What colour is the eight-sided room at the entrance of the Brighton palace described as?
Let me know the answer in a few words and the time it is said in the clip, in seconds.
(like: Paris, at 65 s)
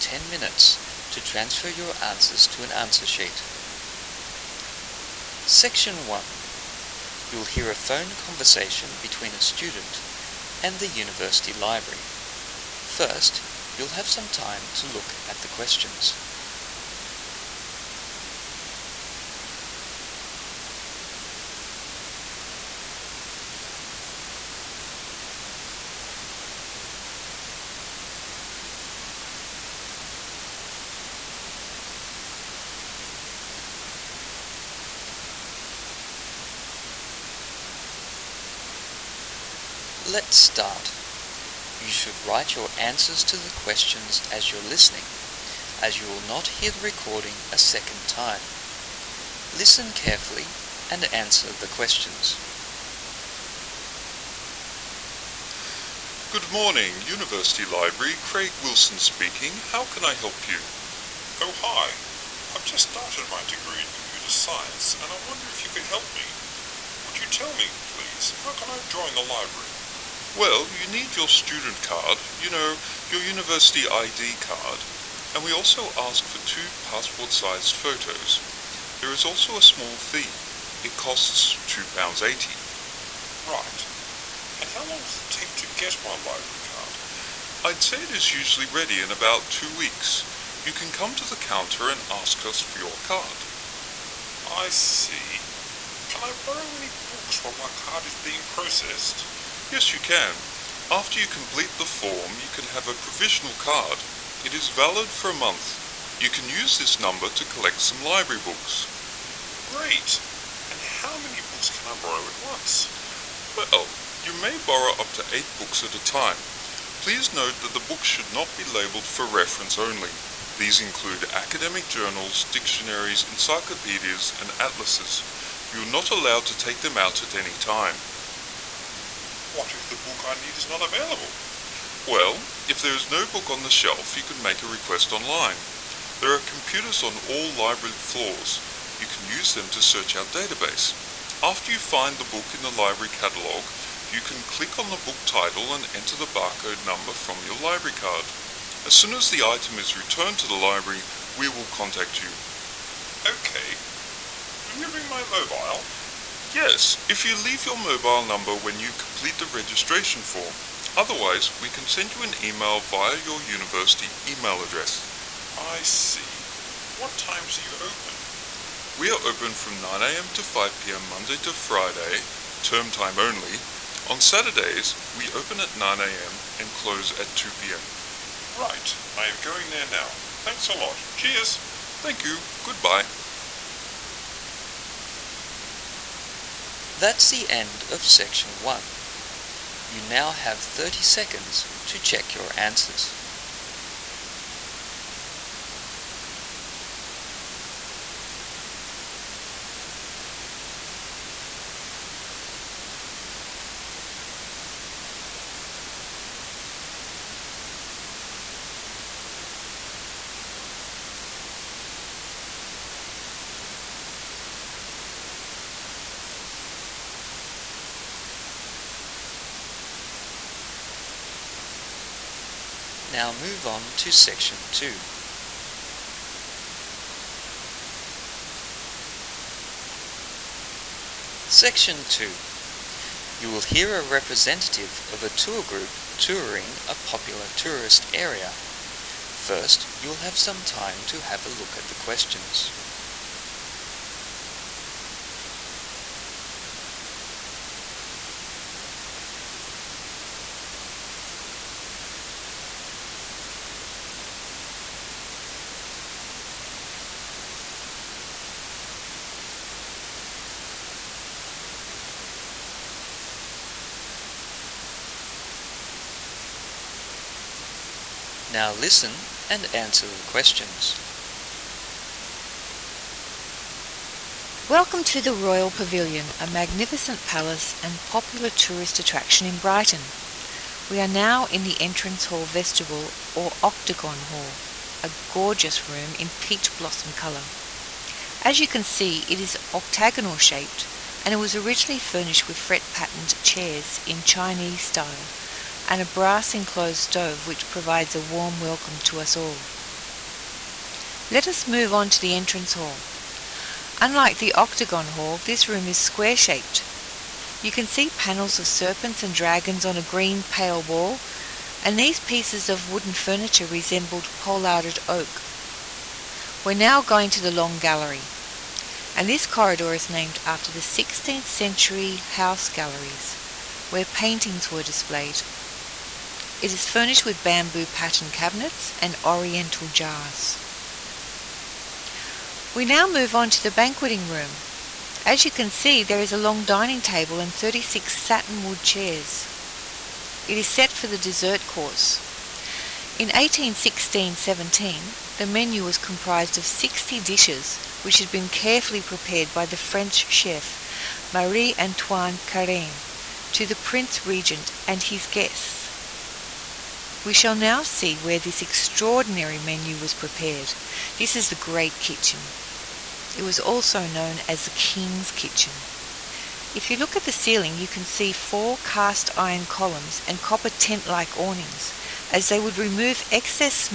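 peach blossom, at 286 s.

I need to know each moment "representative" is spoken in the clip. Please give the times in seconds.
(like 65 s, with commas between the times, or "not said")
234 s.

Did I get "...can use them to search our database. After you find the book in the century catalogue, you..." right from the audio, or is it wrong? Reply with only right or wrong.
wrong.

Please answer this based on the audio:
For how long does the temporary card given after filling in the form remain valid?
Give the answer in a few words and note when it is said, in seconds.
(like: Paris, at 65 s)
a month, at 105 s.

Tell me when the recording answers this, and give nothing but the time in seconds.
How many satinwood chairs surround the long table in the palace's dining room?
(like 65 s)
337 s.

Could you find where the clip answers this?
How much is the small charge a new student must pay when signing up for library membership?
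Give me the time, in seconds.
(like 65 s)
81 s.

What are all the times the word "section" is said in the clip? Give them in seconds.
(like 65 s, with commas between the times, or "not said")
5 s, 188 s, 224 s, 231 s.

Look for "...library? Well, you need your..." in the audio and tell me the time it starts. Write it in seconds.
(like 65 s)
69 s.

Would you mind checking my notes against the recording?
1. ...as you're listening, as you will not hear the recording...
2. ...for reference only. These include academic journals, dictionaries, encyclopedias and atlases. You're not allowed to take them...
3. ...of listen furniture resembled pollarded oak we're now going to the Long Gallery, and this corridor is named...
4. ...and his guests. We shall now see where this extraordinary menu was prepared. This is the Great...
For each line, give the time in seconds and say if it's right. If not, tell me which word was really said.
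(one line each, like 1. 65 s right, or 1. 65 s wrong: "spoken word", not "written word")
1. 44 s right
2. 119 s right
3. 312 s wrong: "wooden", not "listen"
4. 354 s right.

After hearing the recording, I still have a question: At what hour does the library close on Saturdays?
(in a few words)
2pm.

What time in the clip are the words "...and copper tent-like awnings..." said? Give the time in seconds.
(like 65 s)
370 s.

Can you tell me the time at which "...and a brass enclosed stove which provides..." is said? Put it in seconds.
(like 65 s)
295 s.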